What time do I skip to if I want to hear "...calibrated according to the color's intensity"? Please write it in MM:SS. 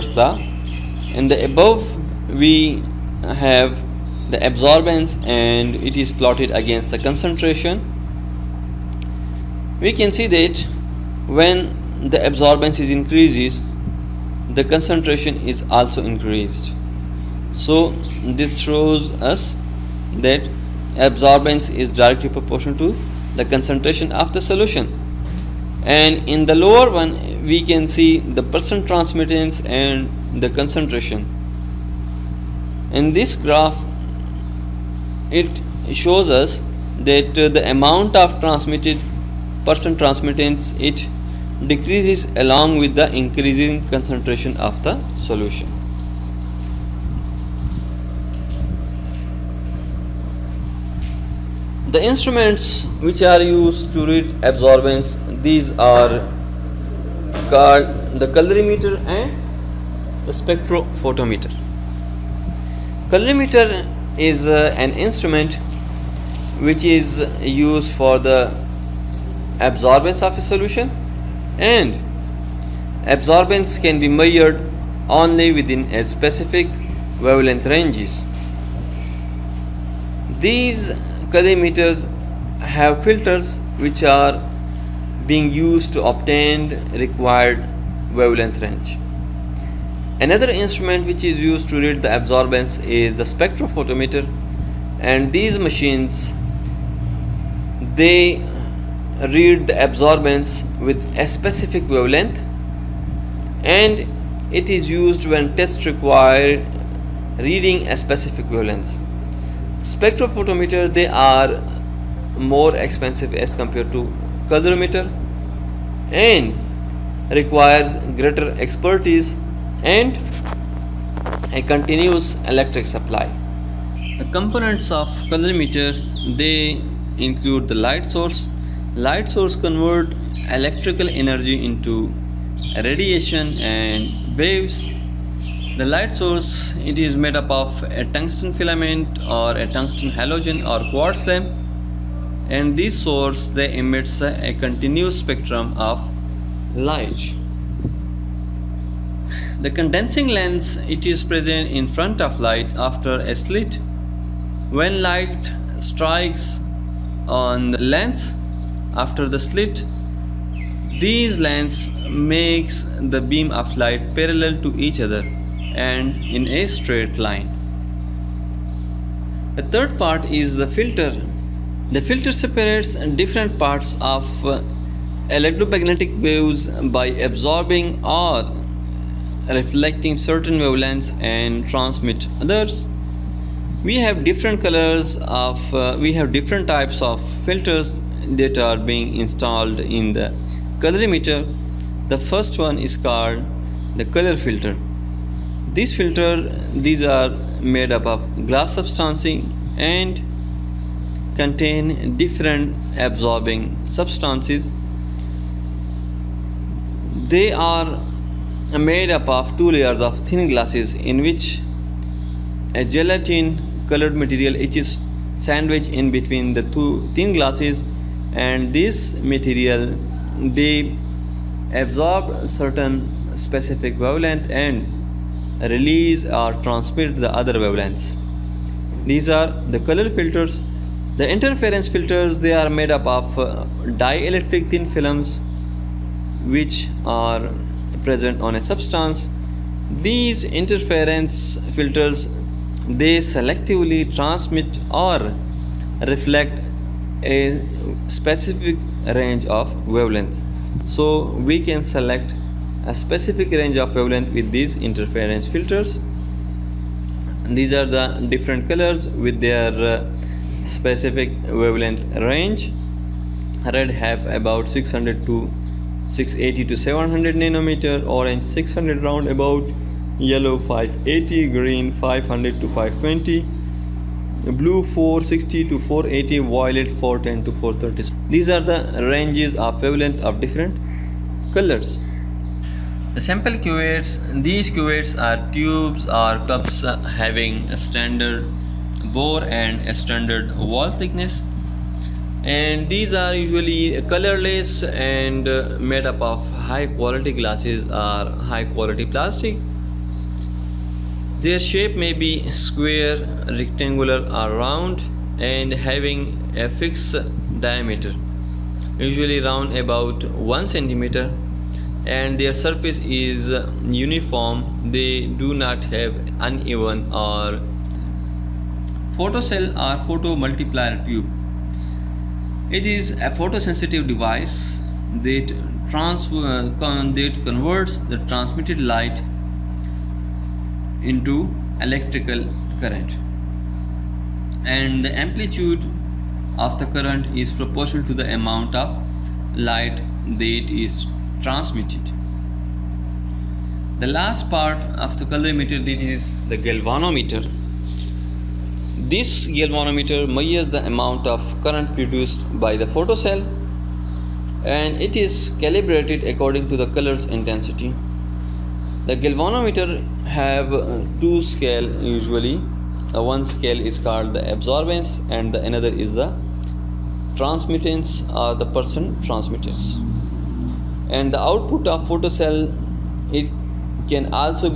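05:55.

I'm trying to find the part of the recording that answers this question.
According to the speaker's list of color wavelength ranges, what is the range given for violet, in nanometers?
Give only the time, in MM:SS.
04:37.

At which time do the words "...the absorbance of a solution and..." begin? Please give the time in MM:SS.
01:08.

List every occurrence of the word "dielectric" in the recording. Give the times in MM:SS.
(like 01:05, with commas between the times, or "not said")
03:53.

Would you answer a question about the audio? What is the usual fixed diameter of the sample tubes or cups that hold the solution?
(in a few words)
1 centimeter.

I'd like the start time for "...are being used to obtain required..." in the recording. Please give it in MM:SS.
01:24.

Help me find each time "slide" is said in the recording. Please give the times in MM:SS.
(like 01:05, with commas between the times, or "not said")
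not said.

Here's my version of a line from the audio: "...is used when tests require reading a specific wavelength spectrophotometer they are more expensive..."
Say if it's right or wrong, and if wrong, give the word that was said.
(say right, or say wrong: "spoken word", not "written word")
right.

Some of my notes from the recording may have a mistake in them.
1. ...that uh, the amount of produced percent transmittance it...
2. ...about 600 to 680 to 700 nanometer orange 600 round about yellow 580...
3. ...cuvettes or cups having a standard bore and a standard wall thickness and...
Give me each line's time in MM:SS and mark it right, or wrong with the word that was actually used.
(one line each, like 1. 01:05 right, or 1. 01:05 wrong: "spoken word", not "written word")
1. 00:36 wrong: "transmitted", not "produced"
2. 04:24 right
3. 04:45 wrong: "tubes", not "cuvettes".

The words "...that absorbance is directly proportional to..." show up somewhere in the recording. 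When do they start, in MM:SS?
00:20.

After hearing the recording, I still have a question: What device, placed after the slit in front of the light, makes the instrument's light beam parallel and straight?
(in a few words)
condensing lens.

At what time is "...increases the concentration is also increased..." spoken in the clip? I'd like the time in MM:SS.
00:12.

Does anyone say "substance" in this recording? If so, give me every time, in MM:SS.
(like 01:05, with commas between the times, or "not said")
03:18, 03:23, 03:58.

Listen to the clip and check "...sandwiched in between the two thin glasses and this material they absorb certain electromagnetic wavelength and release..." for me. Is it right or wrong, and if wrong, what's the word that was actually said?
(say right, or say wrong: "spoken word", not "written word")
wrong: "specific", not "electromagnetic".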